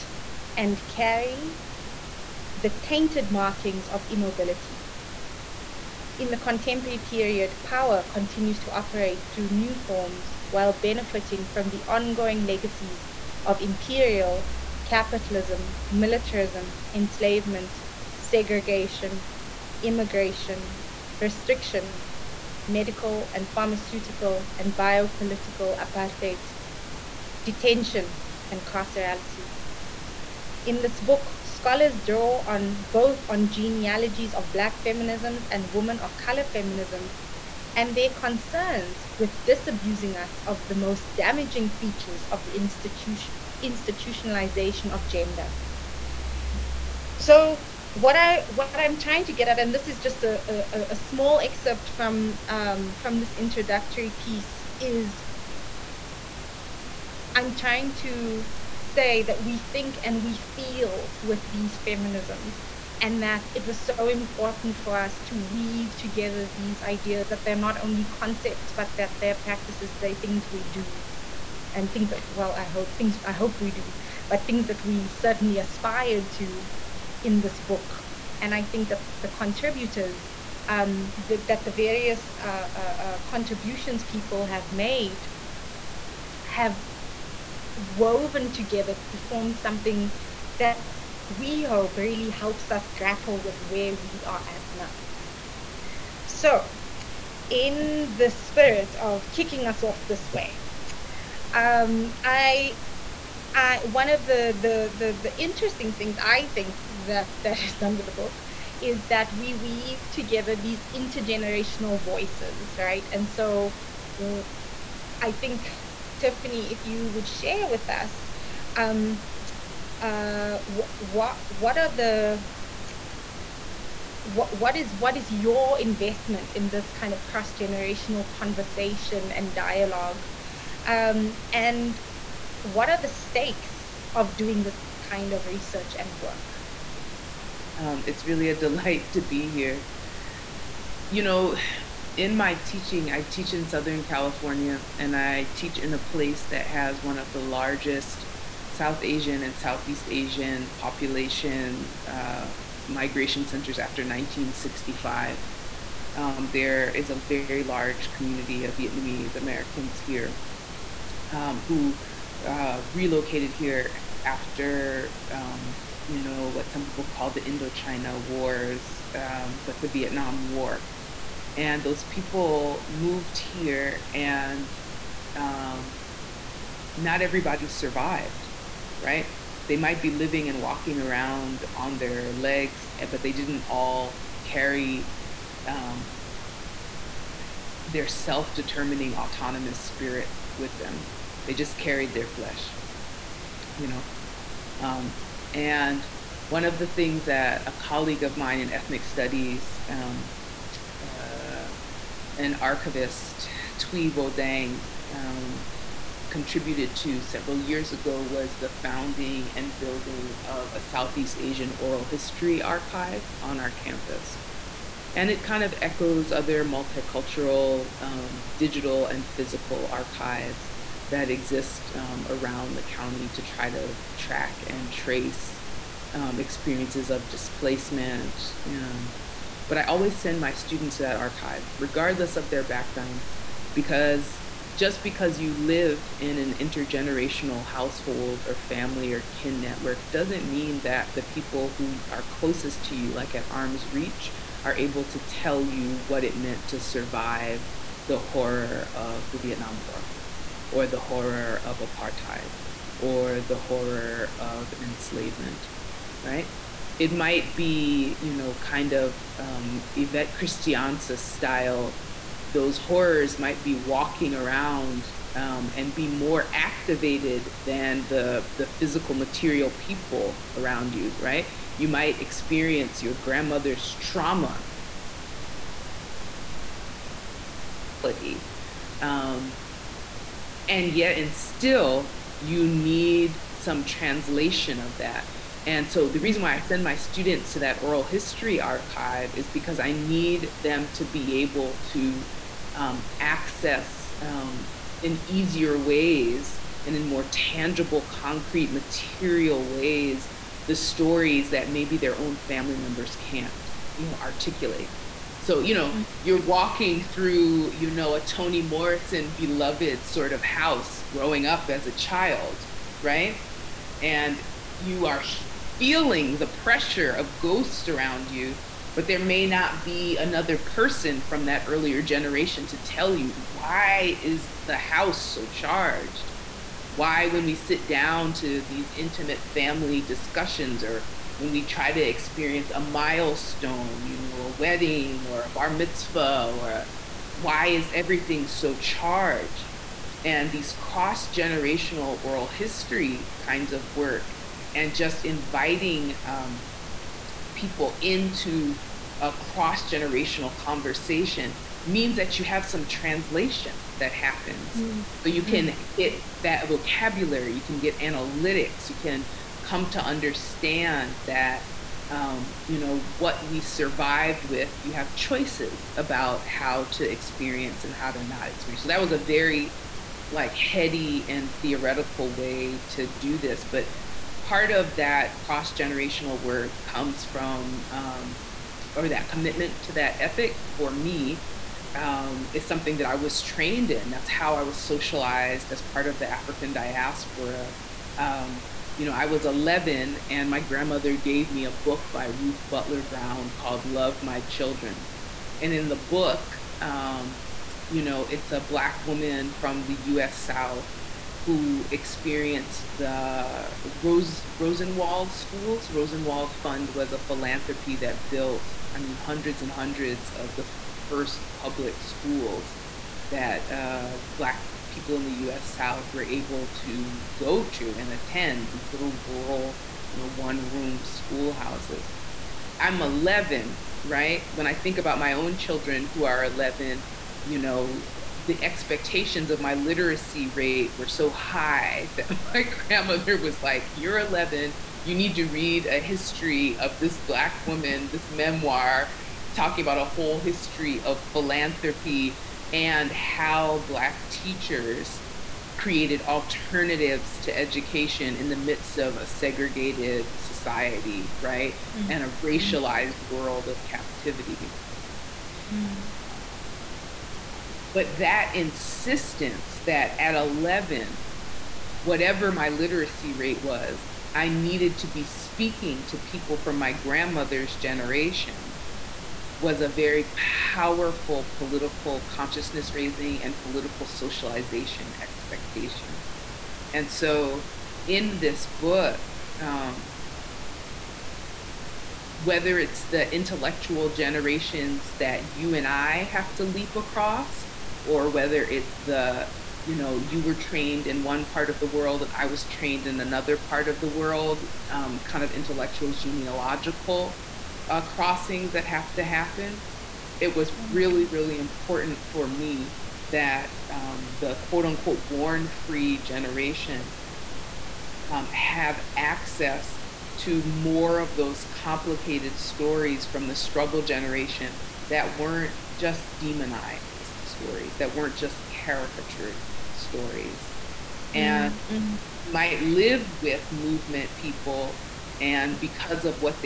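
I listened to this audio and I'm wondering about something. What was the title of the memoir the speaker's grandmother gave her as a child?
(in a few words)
Love My Children.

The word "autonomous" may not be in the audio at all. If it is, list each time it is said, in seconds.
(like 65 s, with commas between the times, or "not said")
189 s.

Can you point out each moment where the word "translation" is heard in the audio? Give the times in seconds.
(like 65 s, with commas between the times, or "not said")
283 s, 352 s.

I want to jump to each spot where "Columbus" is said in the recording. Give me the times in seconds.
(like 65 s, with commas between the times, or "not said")
not said.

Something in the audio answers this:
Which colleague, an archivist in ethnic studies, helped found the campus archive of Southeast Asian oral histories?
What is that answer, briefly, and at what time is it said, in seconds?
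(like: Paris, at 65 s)
Thuy Vo Dang, at 203 s.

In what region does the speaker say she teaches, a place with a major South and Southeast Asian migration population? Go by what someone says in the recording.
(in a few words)
Southern California.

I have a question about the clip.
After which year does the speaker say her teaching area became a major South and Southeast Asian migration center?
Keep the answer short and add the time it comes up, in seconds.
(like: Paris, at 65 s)
1965, at 154 s.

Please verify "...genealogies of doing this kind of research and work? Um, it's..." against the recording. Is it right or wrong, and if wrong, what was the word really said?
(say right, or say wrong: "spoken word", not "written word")
wrong: "stakes", not "genealogies".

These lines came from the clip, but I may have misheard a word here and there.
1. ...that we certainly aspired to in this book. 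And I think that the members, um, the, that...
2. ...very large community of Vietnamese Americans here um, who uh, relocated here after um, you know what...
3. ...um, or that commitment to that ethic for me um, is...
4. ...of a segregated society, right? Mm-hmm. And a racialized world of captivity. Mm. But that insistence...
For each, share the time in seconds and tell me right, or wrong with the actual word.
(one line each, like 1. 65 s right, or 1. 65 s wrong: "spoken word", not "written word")
1. 74 s wrong: "contributors", not "members"
2. 157 s right
3. 377 s right
4. 448 s right.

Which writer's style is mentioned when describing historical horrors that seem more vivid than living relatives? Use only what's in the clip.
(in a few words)
Yvette Christiansa.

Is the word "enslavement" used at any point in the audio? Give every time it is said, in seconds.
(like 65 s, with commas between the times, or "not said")
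16 s, 254 s.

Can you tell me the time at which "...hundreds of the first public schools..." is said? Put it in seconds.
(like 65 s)
409 s.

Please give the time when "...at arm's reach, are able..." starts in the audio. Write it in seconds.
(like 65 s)
243 s.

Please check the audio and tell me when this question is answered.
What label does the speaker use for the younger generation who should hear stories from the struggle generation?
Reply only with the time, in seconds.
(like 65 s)
505 s.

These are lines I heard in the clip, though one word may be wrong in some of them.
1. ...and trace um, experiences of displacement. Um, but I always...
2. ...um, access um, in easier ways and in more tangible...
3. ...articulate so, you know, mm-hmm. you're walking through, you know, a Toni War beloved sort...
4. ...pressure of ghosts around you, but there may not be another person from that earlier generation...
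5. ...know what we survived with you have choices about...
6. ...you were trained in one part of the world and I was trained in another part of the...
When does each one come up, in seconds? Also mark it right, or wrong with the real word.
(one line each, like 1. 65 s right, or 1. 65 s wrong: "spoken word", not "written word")
1. 224 s right
2. 292 s right
3. 304 s wrong: "Morrison", not "War"
4. 316 s right
5. 362 s right
6. 490 s right.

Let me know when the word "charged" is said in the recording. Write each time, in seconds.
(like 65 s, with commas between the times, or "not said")
325 s, 338 s.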